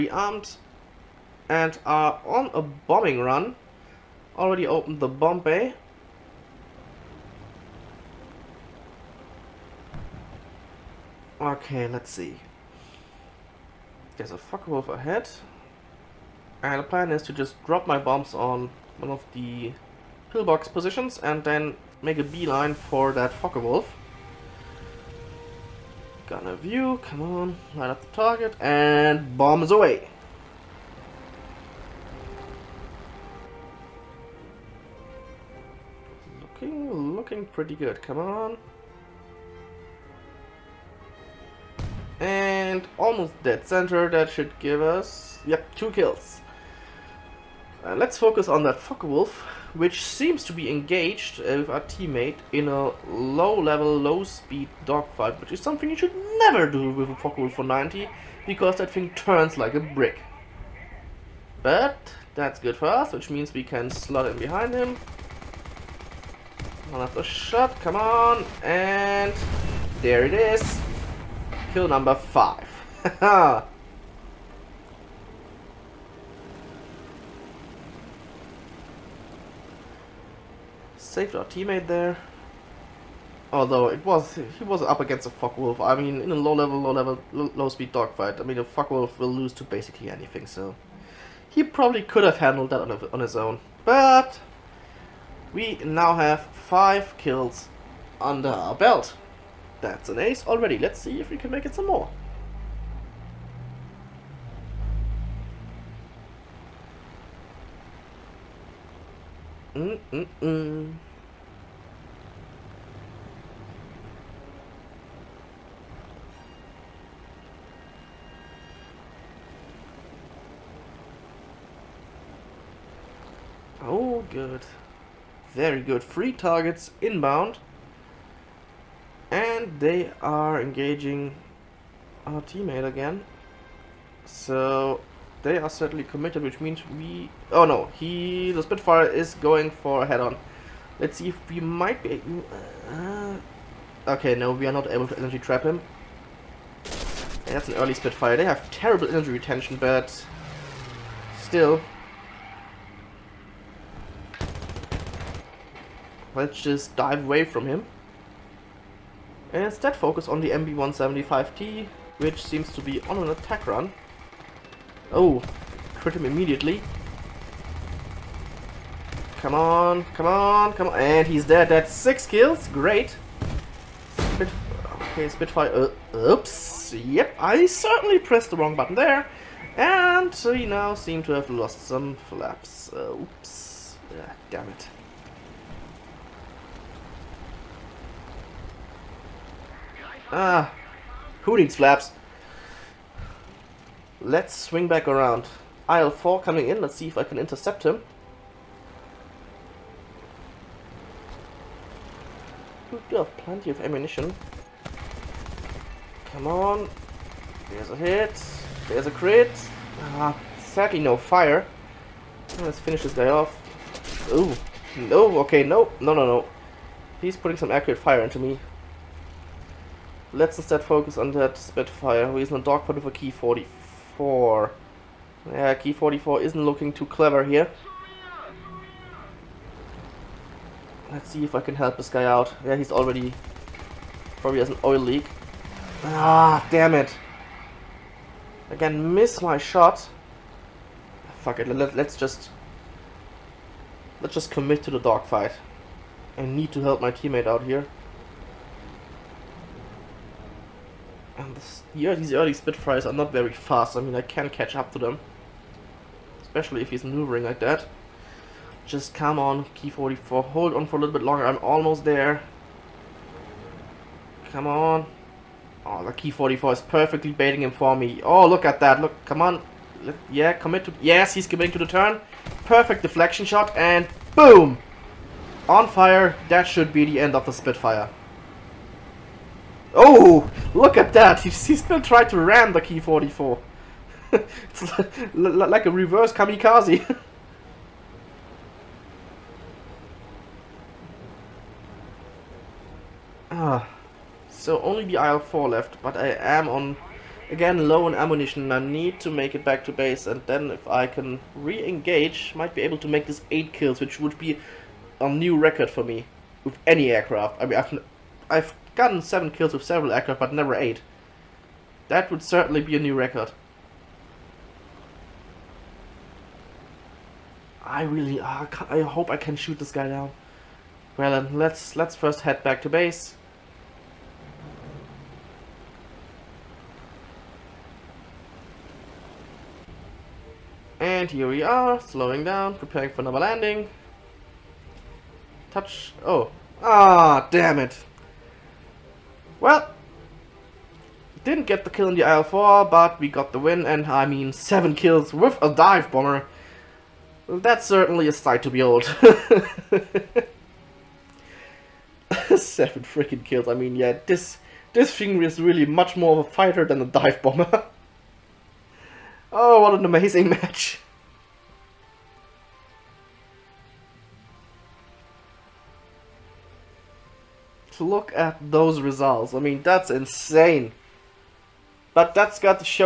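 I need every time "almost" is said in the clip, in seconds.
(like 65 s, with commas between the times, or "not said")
42 s, 261 s.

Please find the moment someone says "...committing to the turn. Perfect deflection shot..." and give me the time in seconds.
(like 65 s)
271 s.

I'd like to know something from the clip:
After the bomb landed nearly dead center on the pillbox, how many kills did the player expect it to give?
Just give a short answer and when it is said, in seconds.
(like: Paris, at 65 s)
2, at 45 s.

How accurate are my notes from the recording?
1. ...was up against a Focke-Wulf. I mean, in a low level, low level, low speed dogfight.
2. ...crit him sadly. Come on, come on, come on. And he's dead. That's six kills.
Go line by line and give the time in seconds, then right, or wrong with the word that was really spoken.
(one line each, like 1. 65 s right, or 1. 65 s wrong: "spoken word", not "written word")
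1. 84 s right
2. 165 s wrong: "immediately", not "sadly".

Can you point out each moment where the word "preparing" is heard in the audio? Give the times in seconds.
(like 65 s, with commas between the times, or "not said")
332 s.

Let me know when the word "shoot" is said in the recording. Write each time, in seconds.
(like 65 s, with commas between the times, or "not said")
319 s.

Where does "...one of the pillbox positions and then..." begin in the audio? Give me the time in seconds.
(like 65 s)
18 s.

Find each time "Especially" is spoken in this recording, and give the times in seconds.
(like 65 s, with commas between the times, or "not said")
256 s.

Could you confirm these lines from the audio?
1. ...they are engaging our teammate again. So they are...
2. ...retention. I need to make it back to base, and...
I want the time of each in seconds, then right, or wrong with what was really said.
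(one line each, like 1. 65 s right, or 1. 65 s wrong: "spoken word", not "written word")
1. 129 s right
2. 298 s wrong: "ammunition", not "retention".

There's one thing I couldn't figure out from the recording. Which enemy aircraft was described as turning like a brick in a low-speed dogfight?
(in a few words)
Focke-Wulf 190.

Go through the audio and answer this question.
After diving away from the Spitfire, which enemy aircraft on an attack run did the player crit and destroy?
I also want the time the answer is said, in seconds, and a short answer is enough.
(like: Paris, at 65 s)
MB175T, at 160 s.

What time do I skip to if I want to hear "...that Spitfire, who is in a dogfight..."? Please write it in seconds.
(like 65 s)
221 s.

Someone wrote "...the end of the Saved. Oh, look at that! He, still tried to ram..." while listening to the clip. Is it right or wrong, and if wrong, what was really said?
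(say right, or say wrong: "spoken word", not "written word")
wrong: "Spitfire", not "Saved".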